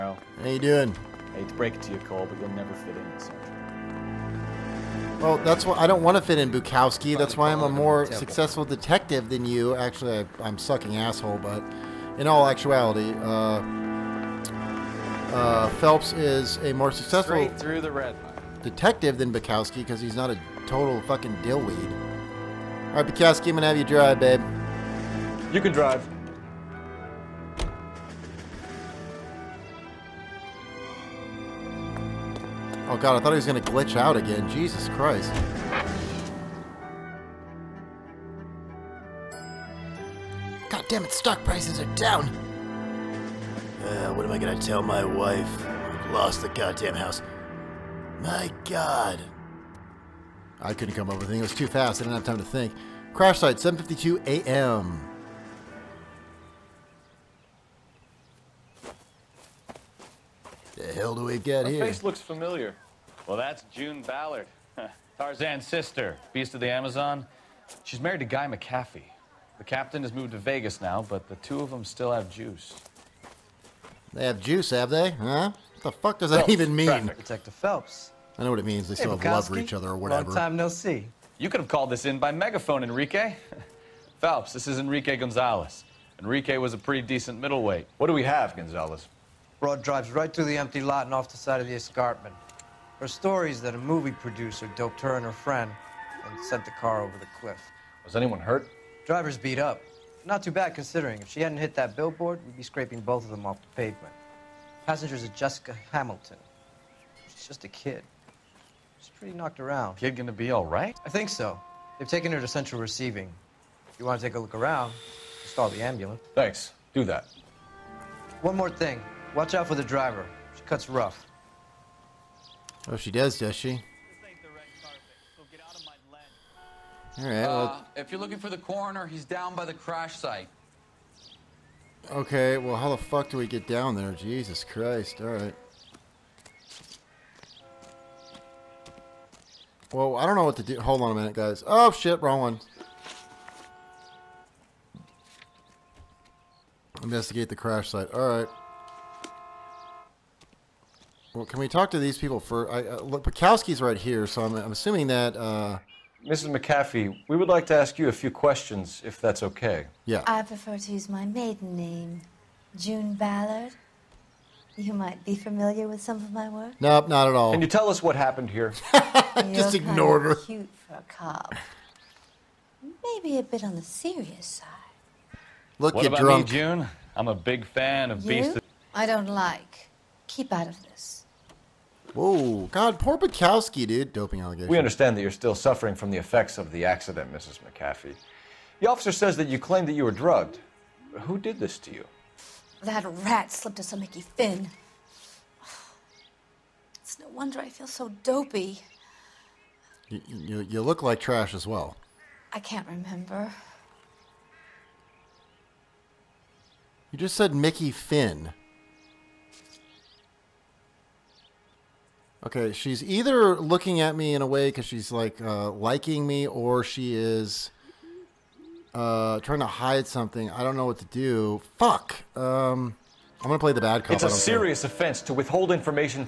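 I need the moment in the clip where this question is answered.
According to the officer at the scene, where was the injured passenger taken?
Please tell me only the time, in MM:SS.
01:52.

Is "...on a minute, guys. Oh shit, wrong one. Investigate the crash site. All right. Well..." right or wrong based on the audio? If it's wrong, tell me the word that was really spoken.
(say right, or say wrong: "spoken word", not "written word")
right.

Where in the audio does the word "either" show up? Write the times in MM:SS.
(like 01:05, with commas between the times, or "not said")
03:33.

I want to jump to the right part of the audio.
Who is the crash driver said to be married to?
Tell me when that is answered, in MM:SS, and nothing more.
01:08.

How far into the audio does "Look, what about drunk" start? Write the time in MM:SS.
02:55.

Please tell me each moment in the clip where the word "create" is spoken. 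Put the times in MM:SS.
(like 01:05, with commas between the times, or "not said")
not said.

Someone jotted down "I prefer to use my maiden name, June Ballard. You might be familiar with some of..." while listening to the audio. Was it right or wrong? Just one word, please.
right.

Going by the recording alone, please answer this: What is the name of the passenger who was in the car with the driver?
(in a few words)
Jessica Hamilton.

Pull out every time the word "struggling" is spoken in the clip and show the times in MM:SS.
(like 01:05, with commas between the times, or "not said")
not said.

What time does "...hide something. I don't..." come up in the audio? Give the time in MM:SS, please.
03:39.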